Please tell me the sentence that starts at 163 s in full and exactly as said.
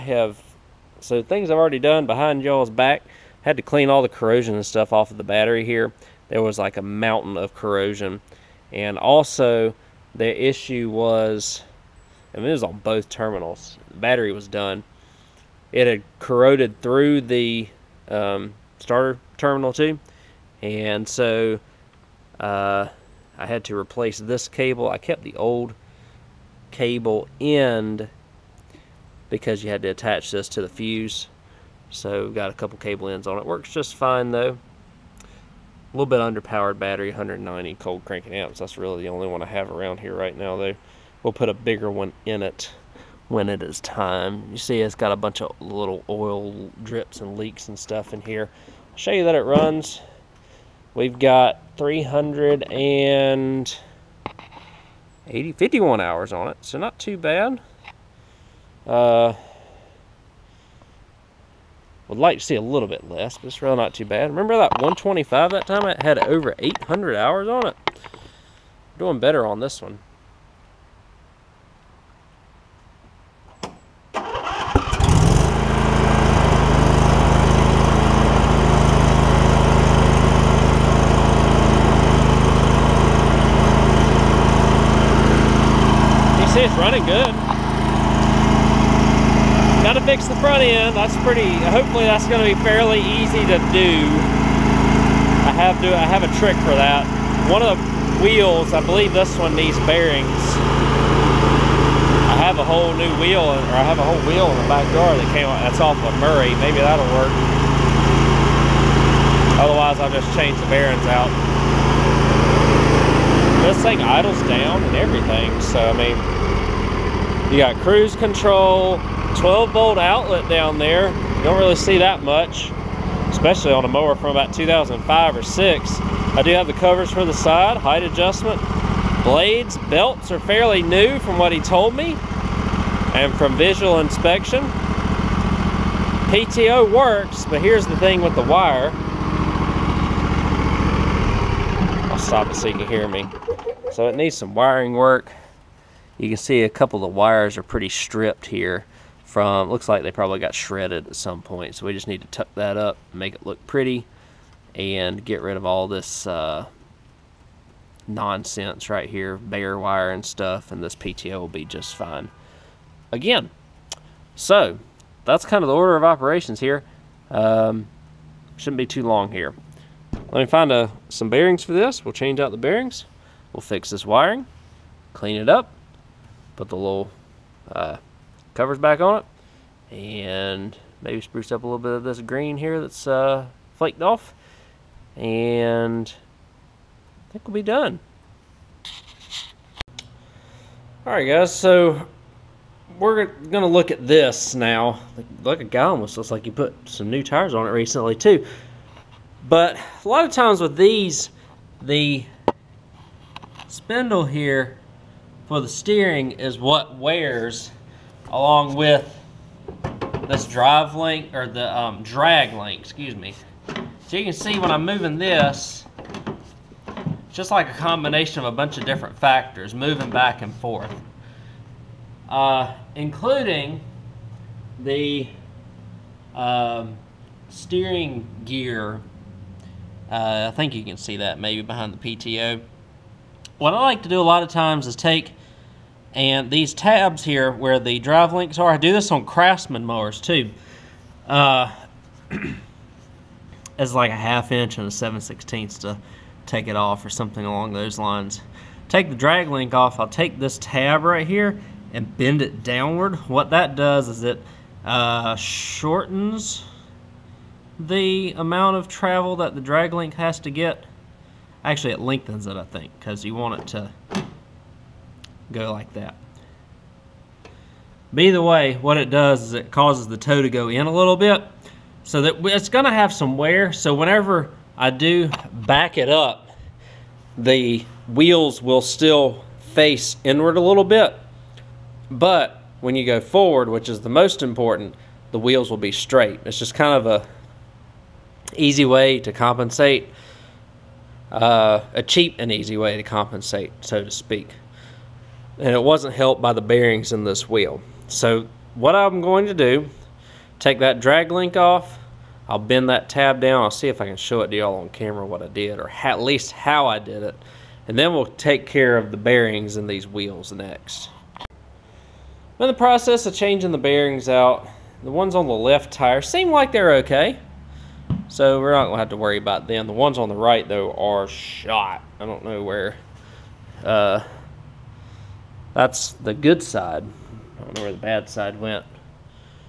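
Again, so that's kind of the order of operations here.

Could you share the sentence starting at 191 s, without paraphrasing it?
Alright guys, so we're going to look at this now.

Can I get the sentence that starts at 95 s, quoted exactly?
I have to, I have a trick for that.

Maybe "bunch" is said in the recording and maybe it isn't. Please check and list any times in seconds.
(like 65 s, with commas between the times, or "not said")
45 s, 218 s.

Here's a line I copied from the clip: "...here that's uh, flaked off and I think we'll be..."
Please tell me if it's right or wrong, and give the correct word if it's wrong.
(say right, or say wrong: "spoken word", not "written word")
right.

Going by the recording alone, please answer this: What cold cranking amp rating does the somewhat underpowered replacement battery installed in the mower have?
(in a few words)
190.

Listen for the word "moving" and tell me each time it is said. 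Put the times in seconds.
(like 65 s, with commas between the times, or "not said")
214 s, 219 s.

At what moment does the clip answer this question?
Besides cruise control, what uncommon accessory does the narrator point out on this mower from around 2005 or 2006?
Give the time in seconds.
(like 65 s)
119 s.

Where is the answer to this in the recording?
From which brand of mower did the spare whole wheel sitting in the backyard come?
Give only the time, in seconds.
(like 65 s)
106 s.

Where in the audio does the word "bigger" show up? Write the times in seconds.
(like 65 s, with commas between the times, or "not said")
41 s.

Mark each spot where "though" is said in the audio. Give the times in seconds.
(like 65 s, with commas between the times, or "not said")
34 s, 40 s, 320 s.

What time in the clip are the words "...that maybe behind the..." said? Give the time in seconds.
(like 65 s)
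231 s.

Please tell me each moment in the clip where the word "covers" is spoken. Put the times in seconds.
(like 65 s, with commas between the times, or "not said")
126 s, 178 s.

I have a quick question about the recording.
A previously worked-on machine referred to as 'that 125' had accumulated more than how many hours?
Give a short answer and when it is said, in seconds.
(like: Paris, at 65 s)
800, at 66 s.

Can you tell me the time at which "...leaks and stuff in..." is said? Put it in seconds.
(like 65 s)
47 s.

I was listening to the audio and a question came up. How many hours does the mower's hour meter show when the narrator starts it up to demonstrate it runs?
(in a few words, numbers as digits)
351.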